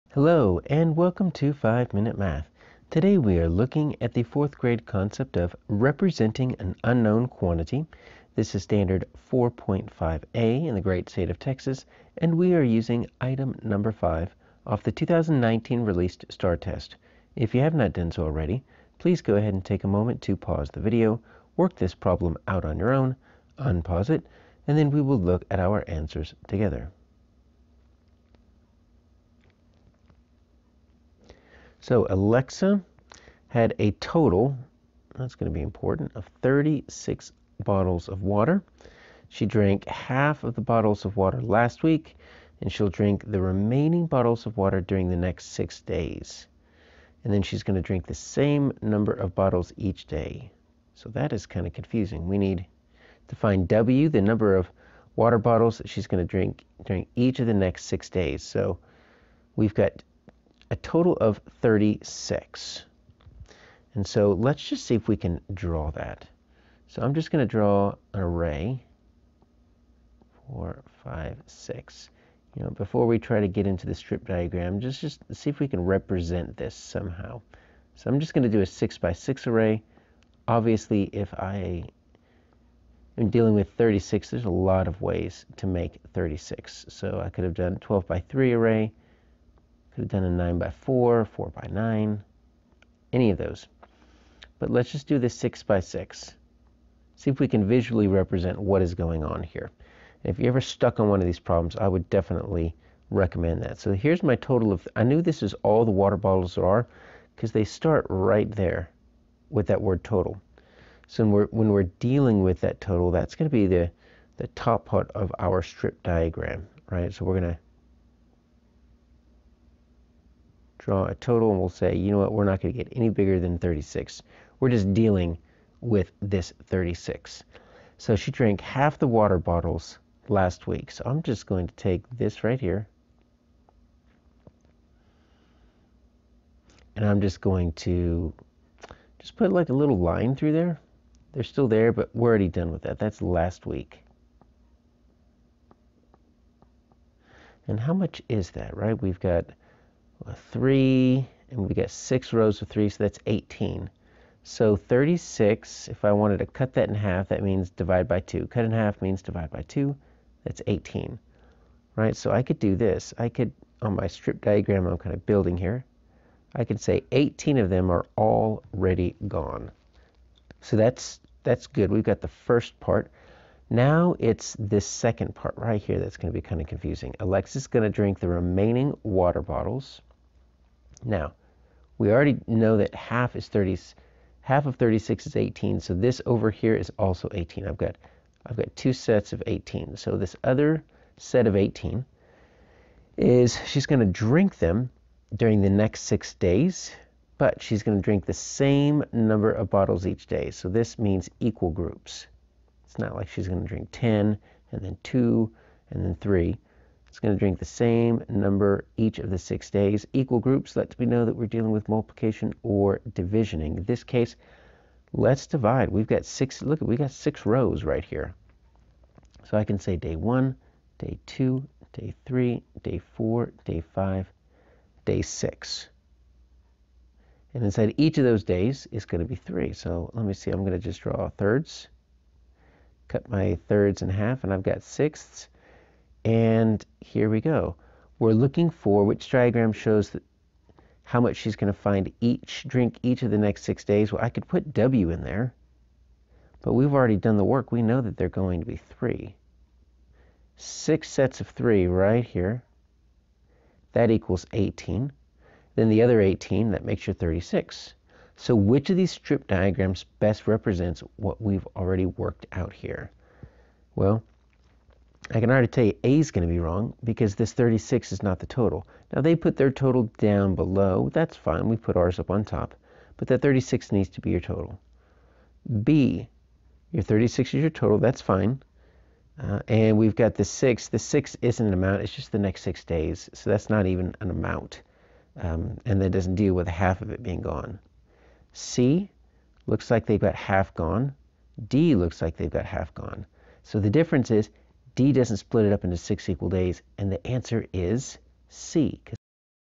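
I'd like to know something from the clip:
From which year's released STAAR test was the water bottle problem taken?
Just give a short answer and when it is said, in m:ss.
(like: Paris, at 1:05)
2019, at 0:14.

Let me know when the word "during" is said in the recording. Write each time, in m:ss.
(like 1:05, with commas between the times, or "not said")
0:44, 0:56, 3:15.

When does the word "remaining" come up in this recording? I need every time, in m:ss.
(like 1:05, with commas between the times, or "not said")
0:43, 2:58.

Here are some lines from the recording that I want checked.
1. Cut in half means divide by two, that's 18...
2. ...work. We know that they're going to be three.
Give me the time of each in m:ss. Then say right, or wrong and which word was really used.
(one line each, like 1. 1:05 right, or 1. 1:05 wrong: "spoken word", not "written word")
1. 2:38 right
2. 4:07 right.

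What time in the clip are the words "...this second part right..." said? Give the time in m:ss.
2:54.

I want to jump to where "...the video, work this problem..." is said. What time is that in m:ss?
0:20.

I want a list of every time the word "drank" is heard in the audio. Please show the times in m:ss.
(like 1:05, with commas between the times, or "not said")
0:39, 2:08.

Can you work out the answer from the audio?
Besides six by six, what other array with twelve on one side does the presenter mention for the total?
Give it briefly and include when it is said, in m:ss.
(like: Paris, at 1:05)
12 by 3, at 1:27.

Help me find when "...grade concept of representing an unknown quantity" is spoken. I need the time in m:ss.
0:04.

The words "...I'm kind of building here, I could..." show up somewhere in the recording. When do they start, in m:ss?
2:44.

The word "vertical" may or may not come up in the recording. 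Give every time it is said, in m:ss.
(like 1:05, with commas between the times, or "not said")
not said.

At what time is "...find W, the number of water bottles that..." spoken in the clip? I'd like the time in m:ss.
0:53.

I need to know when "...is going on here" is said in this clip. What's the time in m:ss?
1:38.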